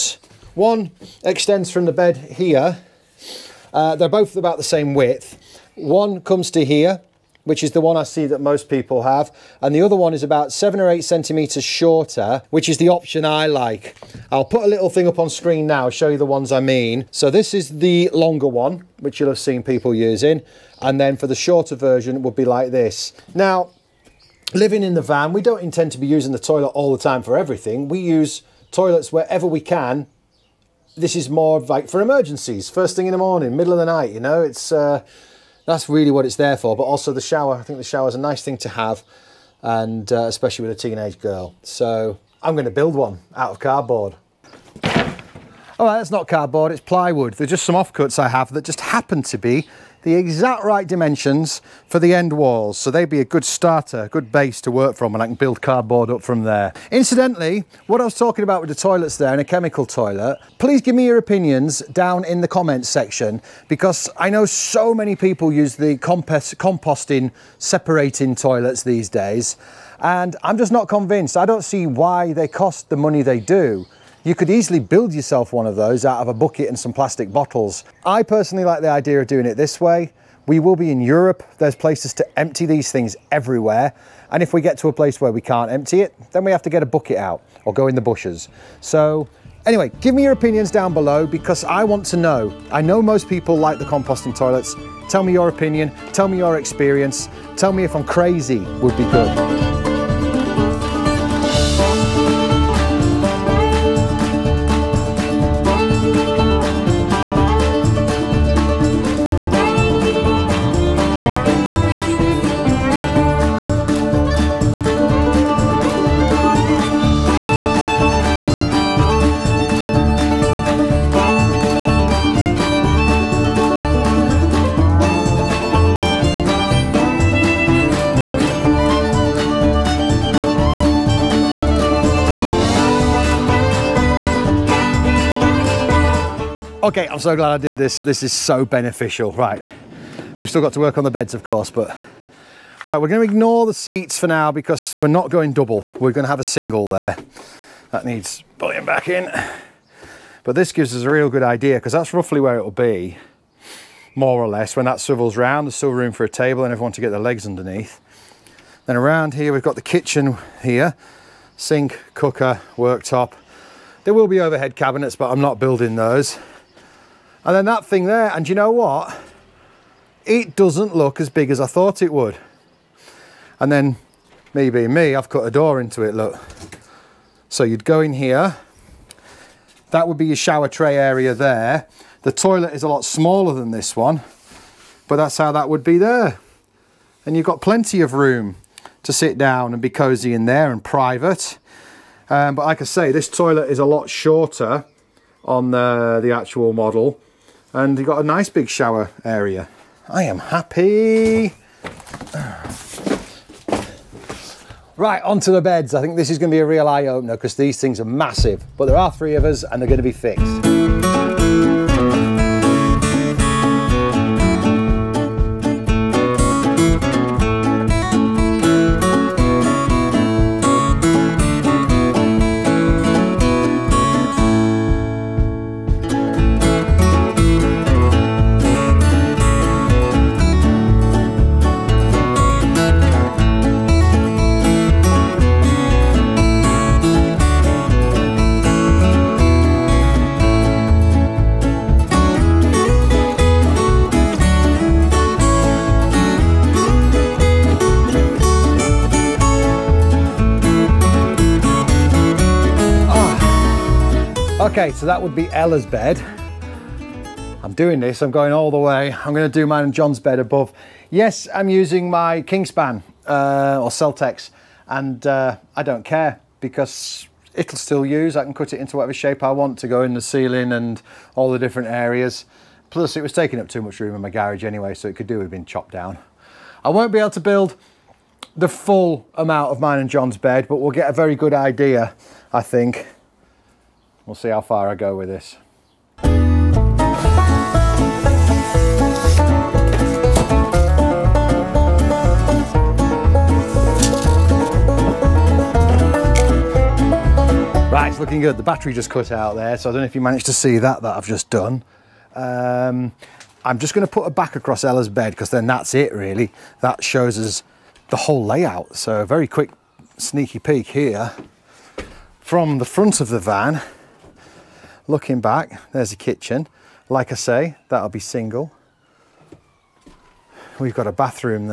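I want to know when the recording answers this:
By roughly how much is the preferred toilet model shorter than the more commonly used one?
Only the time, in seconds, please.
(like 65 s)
10 s.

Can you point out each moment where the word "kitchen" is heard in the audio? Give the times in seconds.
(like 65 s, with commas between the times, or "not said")
159 s, 316 s.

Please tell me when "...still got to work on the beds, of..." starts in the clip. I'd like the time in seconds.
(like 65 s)
140 s.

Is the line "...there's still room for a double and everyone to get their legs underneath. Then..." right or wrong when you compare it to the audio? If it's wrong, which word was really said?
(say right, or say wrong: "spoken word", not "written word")
wrong: "table", not "double".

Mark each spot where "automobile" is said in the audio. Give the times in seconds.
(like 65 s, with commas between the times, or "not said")
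not said.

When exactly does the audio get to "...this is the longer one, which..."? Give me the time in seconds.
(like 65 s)
17 s.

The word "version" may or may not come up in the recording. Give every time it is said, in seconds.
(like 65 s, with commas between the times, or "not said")
21 s.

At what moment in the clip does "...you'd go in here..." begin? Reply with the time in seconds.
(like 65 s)
177 s.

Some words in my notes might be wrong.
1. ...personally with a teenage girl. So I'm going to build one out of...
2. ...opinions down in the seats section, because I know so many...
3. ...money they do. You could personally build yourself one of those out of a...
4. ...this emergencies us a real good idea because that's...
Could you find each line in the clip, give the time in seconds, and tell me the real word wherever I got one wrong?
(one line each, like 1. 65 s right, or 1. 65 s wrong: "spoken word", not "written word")
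1. 40 s wrong: "especially", not "personally"
2. 61 s wrong: "comments", not "seats"
3. 72 s wrong: "easily", not "personally"
4. 150 s wrong: "gives", not "emergencies".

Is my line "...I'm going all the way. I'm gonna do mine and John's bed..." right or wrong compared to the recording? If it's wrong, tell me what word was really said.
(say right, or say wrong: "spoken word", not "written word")
right.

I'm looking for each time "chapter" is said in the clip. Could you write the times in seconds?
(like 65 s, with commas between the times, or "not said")
not said.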